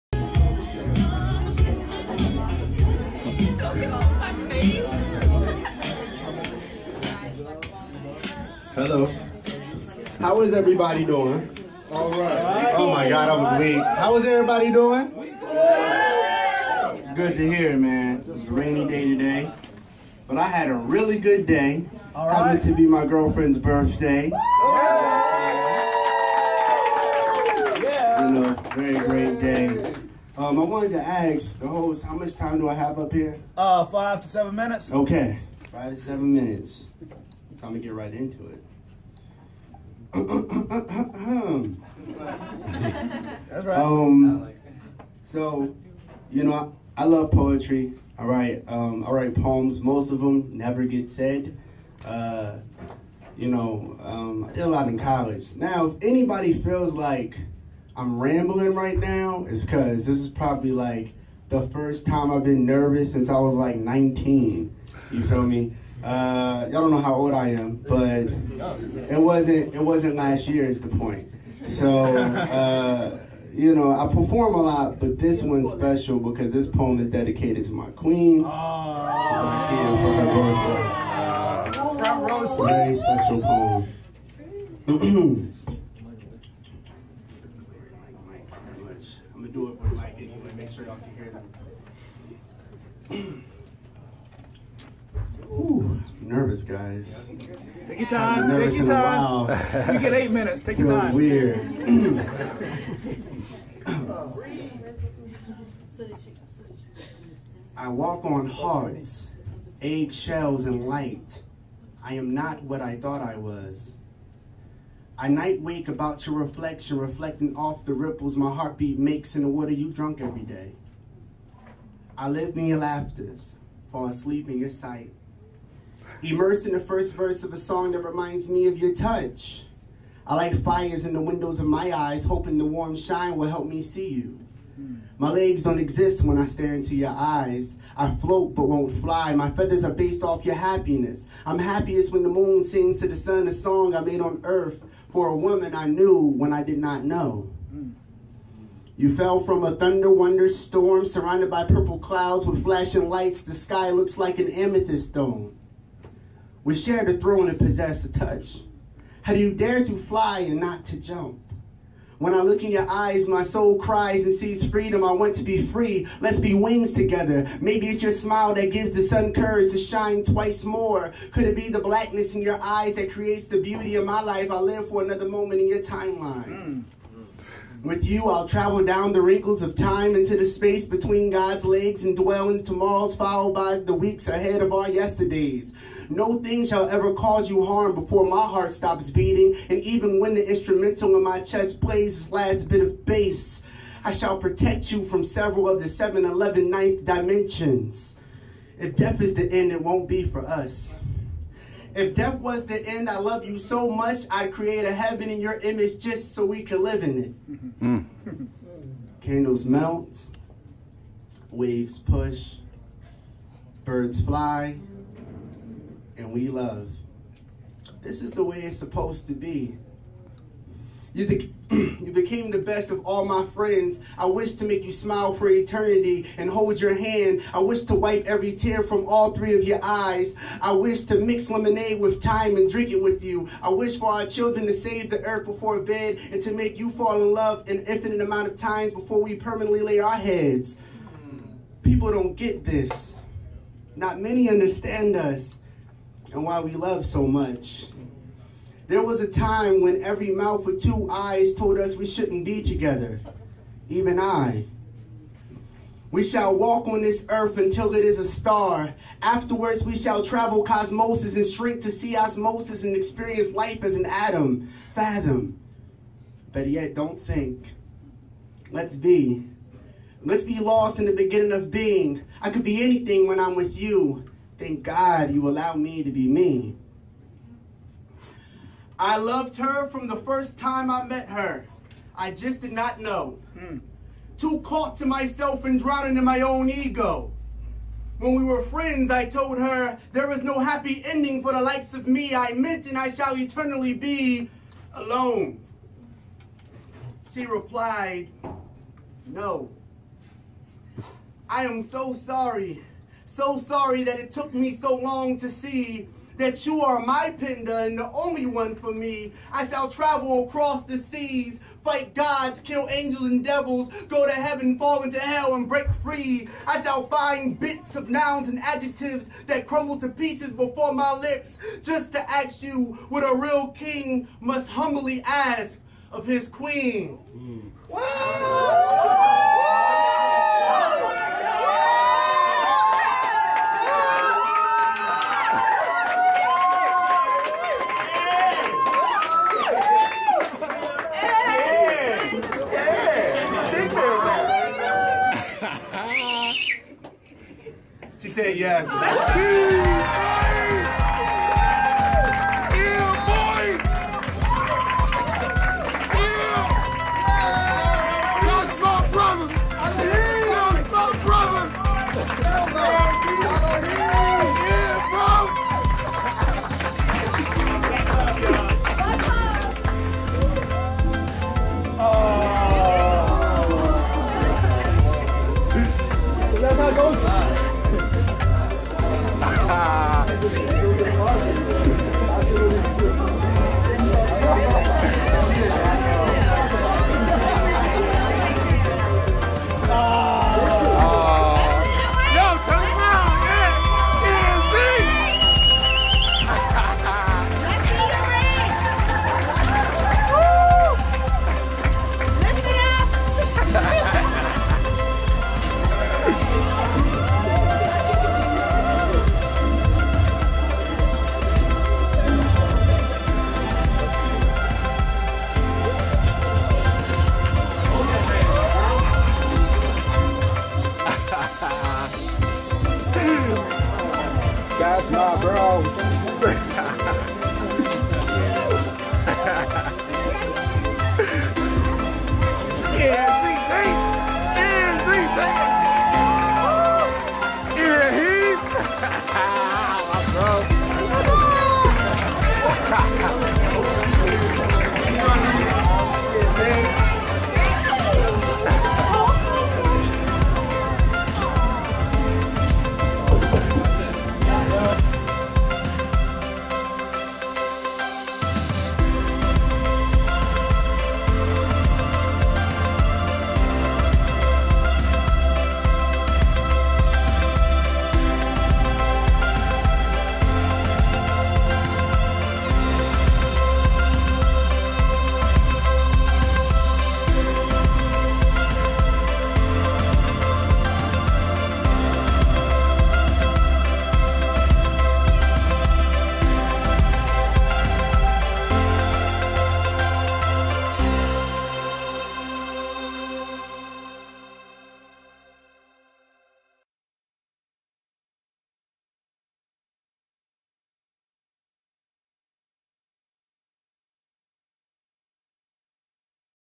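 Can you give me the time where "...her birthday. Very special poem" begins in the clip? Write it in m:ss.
1:22.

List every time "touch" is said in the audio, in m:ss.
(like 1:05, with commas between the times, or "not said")
2:08, 2:38.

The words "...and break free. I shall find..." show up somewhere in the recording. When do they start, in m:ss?
5:15.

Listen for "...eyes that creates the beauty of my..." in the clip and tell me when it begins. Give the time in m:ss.
2:52.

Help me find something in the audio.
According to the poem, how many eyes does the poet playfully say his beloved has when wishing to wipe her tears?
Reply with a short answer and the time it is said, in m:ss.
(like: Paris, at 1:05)
3, at 3:49.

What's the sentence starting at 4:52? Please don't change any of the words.
I meant and I shall eternally be alone.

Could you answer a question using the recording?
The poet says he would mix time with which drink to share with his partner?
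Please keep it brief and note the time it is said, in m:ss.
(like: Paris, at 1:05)
Lemonade, at 3:51.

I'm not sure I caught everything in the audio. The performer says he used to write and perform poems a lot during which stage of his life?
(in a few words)
College.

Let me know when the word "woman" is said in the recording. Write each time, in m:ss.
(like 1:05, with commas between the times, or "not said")
2:25.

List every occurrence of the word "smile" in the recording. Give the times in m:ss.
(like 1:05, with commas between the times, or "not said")
2:48, 3:44.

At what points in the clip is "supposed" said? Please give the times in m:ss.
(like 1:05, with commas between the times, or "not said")
3:38.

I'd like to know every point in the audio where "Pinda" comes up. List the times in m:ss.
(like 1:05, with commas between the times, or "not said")
5:07.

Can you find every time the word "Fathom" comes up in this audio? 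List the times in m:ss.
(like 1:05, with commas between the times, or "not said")
4:24.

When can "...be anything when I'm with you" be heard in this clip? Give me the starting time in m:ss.
4:32.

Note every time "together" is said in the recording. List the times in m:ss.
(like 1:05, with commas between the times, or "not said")
2:46, 4:12.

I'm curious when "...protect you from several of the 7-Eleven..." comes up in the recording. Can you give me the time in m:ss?
3:14.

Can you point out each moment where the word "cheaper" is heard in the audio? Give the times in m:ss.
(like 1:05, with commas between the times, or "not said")
not said.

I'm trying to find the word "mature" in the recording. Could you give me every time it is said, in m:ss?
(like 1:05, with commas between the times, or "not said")
not said.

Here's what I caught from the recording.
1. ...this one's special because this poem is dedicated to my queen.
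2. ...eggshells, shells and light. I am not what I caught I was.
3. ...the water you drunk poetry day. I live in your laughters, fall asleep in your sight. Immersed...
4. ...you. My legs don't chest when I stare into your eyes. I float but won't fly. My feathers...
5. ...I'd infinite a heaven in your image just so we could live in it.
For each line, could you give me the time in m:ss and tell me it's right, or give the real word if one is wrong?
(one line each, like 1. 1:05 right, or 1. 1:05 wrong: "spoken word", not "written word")
1. 1:15 right
2. 1:49 wrong: "thought", not "caught"
3. 1:59 wrong: "every", not "poetry"
4. 2:14 wrong: "exist", not "chest"
5. 3:24 wrong: "create", not "infinite".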